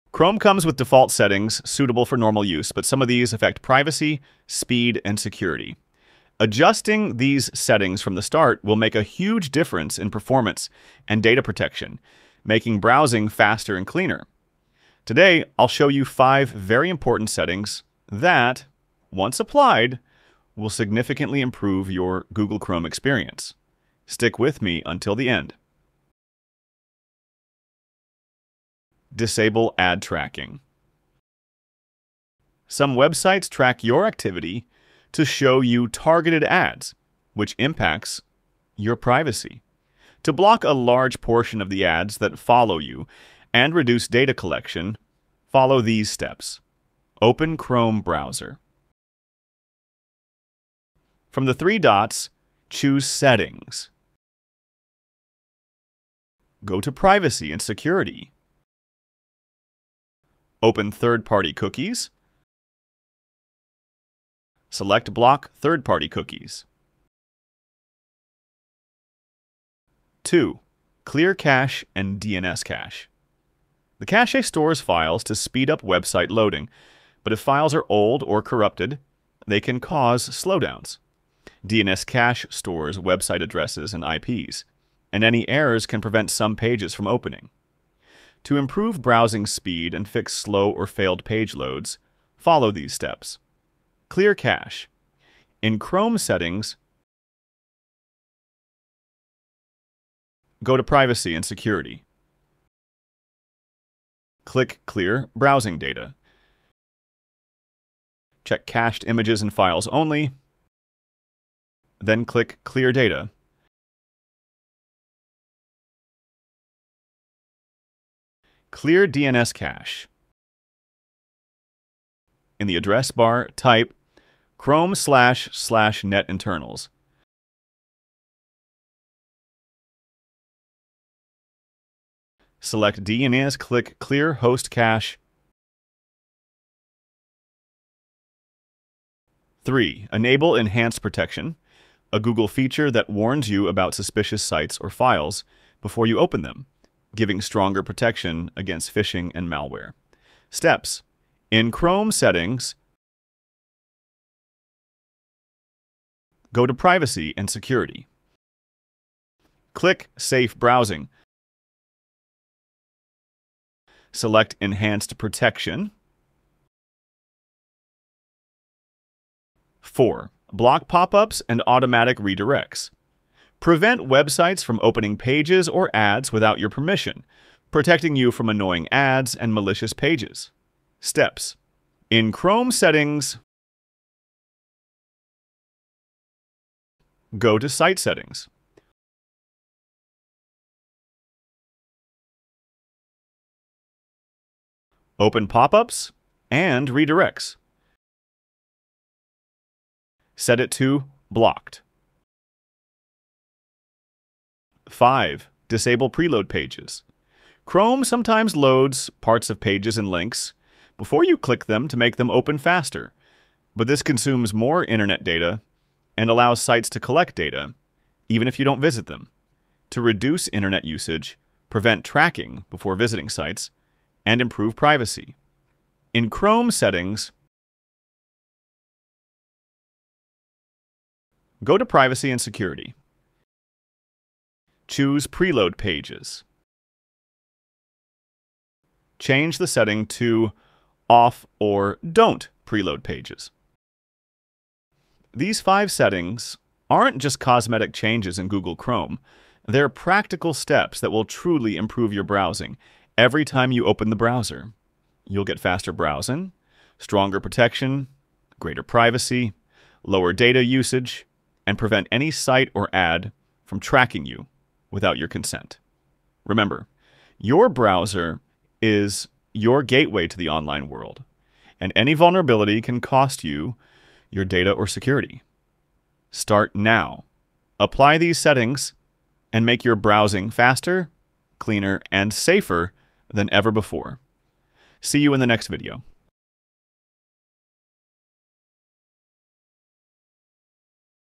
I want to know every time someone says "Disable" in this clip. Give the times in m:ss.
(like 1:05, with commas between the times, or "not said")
0:29, 3:25.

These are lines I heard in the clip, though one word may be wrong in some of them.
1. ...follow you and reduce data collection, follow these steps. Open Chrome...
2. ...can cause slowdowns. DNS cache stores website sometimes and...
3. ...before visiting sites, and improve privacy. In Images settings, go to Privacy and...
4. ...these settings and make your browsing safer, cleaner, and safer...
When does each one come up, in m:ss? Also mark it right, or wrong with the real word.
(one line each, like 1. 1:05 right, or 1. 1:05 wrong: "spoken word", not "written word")
1. 0:42 right
2. 1:19 wrong: "addresses", not "sometimes"
3. 3:42 wrong: "Chrome", not "Images"
4. 4:38 wrong: "faster", not "safer".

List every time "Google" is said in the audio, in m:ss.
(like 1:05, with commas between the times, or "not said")
0:22, 2:22, 4:08.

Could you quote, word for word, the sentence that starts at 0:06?
Adjusting these settings from the start will make a huge difference in performance and data protection, making browsing faster and cleaner.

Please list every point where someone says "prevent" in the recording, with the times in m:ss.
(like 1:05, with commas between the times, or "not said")
1:26, 2:53, 3:41, 4:21.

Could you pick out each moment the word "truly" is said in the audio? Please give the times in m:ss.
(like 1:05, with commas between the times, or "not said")
4:11.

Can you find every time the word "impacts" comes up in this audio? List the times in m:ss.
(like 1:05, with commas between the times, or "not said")
0:37.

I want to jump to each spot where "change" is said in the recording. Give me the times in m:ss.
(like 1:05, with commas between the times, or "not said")
3:59, 4:07.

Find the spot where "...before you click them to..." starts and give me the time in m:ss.
3:30.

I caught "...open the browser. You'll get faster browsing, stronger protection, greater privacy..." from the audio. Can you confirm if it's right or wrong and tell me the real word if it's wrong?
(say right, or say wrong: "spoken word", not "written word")
right.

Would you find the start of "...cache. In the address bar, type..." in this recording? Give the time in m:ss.
1:59.